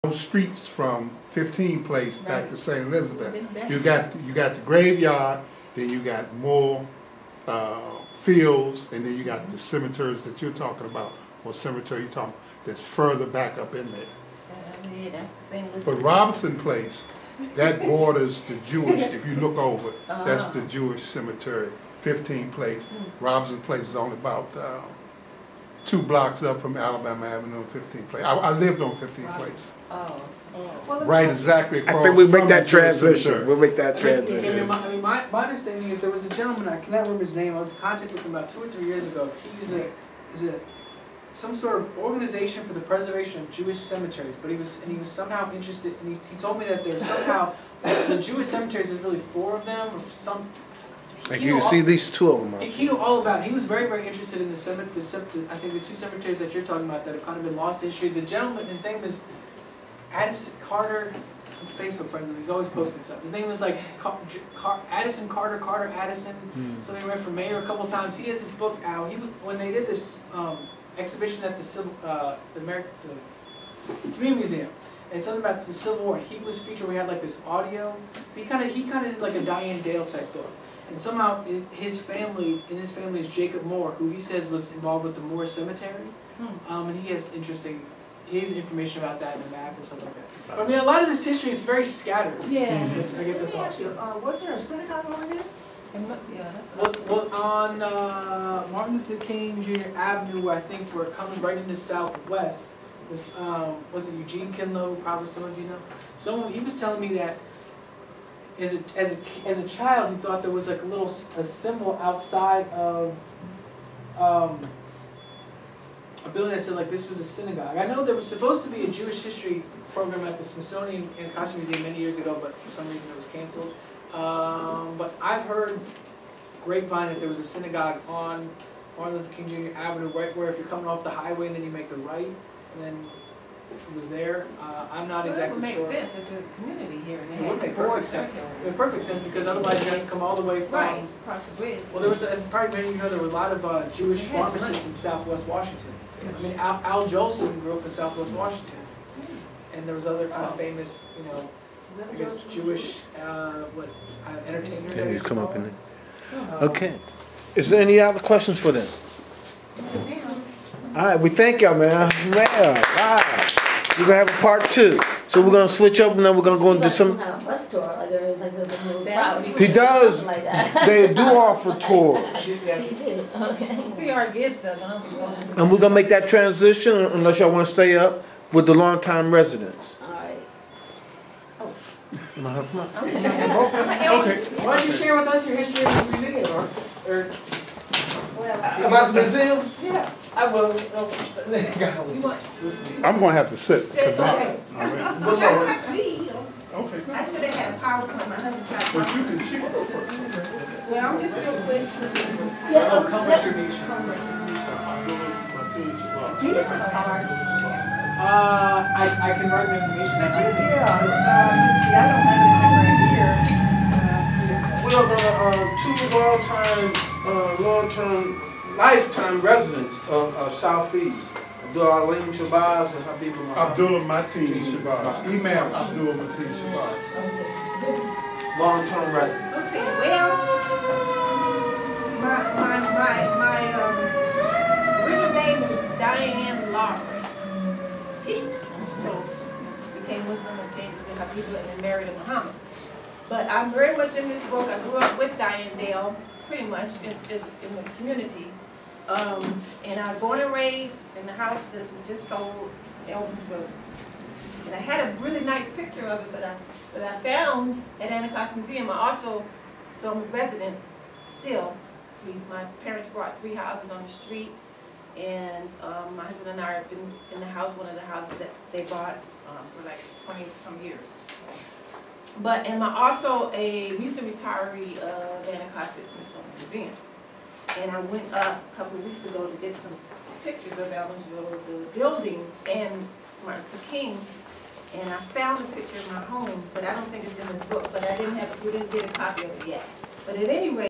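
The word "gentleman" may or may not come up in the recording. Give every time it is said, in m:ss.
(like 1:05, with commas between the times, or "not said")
0:36, 0:58.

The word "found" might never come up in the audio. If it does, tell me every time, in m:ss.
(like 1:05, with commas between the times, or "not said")
4:17, 4:45.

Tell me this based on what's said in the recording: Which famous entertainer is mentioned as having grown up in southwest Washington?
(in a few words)
Al Jolson.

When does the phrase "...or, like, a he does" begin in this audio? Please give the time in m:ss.
2:48.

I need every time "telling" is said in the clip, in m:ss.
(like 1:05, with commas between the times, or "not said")
1:46.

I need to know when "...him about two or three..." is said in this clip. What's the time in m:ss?
0:38.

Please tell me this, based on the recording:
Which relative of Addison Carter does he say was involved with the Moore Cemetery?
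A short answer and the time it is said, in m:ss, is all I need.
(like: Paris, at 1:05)
Jacob Moore, at 1:23.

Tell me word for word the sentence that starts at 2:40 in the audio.
All right, we thank y'all, man.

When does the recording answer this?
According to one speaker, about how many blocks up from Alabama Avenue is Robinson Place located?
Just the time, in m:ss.
0:25.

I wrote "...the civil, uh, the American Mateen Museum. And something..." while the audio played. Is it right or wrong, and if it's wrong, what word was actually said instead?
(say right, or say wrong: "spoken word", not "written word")
wrong: "Community", not "Mateen".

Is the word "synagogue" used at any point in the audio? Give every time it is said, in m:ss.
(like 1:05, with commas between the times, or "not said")
1:34, 1:57, 2:07.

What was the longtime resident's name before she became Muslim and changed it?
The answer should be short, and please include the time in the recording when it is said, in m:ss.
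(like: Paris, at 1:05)
Diane Lawrence, at 3:56.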